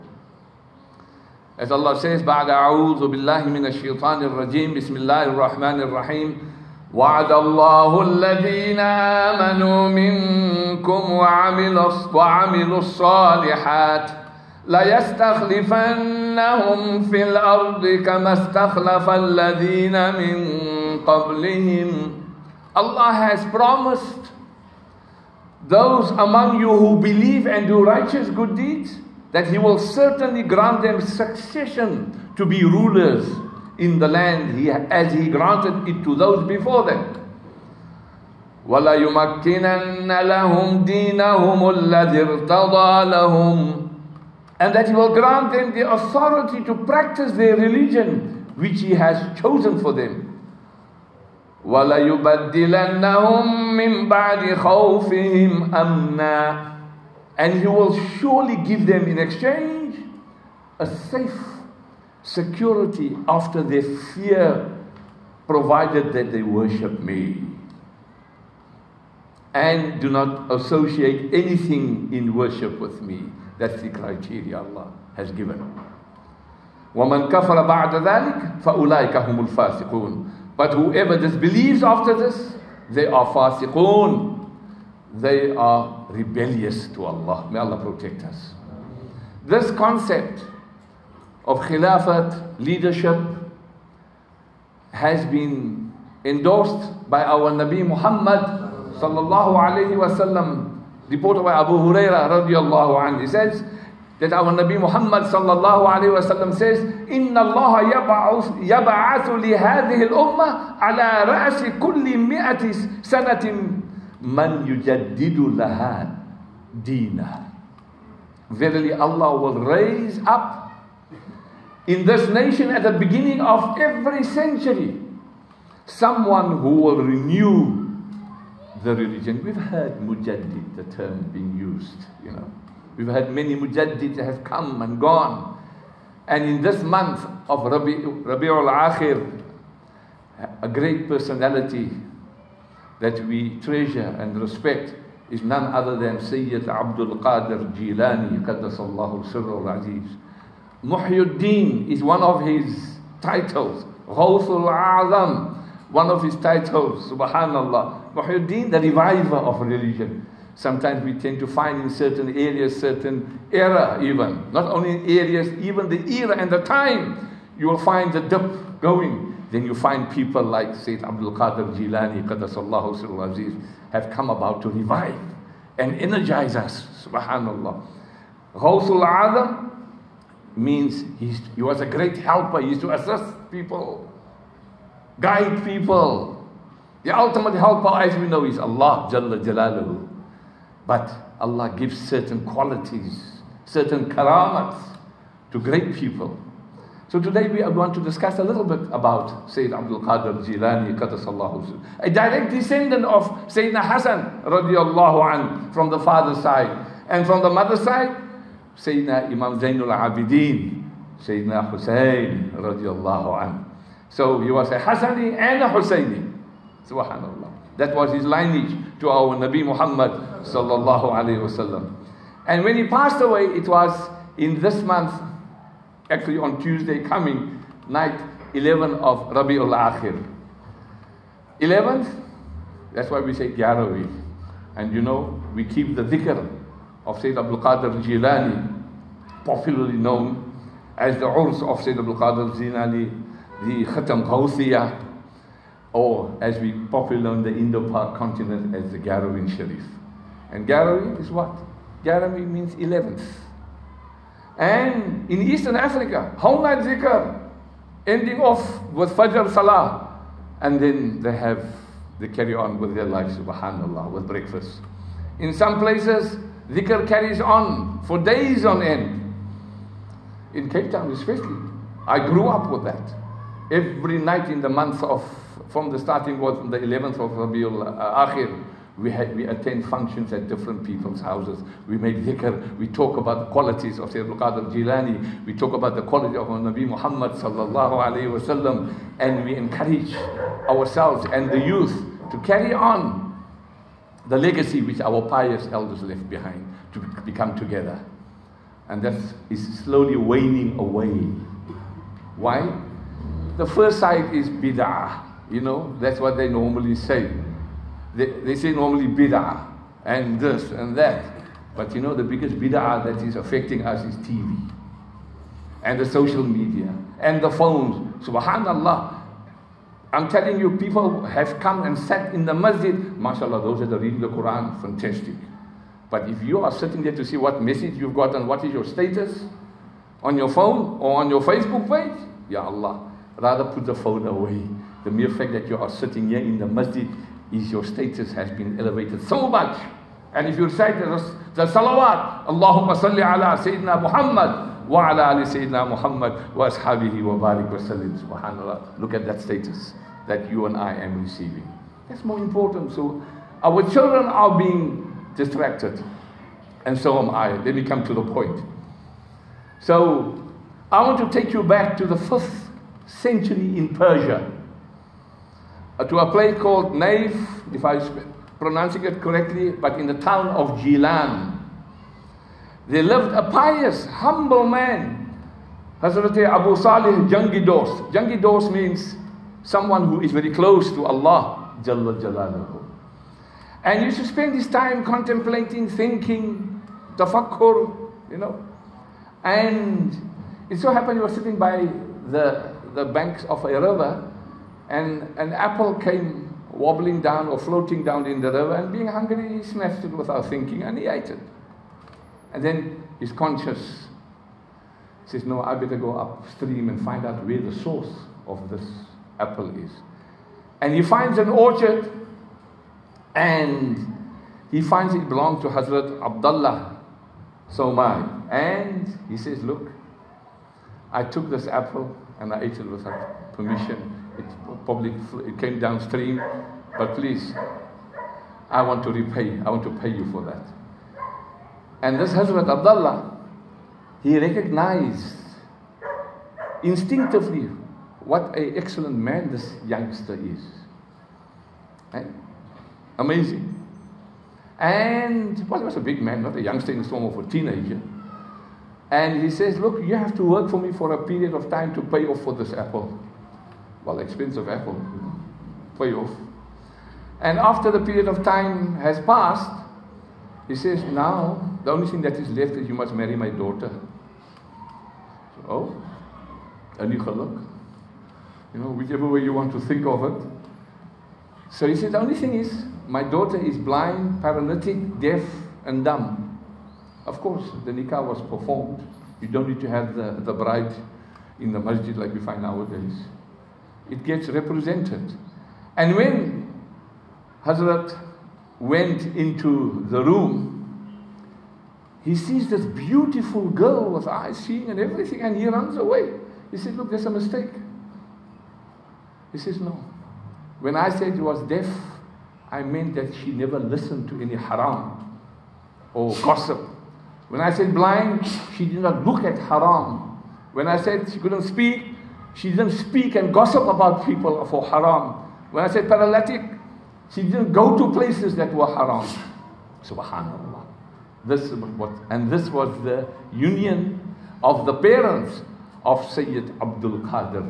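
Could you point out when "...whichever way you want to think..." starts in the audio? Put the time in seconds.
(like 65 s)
468 s.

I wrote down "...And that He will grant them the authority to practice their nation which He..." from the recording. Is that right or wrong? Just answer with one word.
wrong.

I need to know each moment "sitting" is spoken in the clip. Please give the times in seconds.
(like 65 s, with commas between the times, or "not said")
326 s, 335 s, 391 s.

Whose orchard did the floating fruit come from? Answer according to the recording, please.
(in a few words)
Hazrat Abdullah Somai.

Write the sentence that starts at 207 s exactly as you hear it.
And from the mother's side, Sayyidina Imam Zainul Abidin, Sayyidina Hussein radiallahu an.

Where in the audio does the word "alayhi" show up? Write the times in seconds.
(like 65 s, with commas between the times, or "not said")
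99 s, 288 s.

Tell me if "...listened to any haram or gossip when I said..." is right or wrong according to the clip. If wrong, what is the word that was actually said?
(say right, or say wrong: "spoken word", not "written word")
right.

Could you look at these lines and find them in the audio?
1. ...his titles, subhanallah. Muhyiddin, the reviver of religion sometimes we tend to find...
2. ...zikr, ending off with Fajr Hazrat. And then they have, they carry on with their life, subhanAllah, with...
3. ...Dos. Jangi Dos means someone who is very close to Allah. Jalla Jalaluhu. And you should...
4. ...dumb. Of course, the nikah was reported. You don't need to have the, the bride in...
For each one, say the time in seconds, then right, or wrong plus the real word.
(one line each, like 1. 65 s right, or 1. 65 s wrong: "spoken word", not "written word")
1. 156 s right
2. 256 s wrong: "Salah", not "Hazrat"
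3. 377 s right
4. 476 s wrong: "performed", not "reported".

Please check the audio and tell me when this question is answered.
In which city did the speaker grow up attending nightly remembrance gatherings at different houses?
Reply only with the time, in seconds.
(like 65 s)
270 s.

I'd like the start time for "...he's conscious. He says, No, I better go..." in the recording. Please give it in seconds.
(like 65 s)
403 s.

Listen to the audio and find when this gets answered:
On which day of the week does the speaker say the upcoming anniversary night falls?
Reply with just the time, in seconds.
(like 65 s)
226 s.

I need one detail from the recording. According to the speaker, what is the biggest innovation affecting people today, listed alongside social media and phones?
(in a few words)
TV.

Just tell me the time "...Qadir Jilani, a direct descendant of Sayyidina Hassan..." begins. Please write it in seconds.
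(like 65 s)
200 s.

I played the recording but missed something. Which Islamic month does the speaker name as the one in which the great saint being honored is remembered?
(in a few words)
Rabi'ul Akhir.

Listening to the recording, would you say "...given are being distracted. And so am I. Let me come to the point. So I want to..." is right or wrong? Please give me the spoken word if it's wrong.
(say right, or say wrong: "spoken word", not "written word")
wrong: "children", not "given".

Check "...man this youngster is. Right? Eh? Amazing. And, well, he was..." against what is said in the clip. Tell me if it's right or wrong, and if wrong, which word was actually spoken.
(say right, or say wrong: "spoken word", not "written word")
right.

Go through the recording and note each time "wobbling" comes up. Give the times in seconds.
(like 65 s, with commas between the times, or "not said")
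396 s.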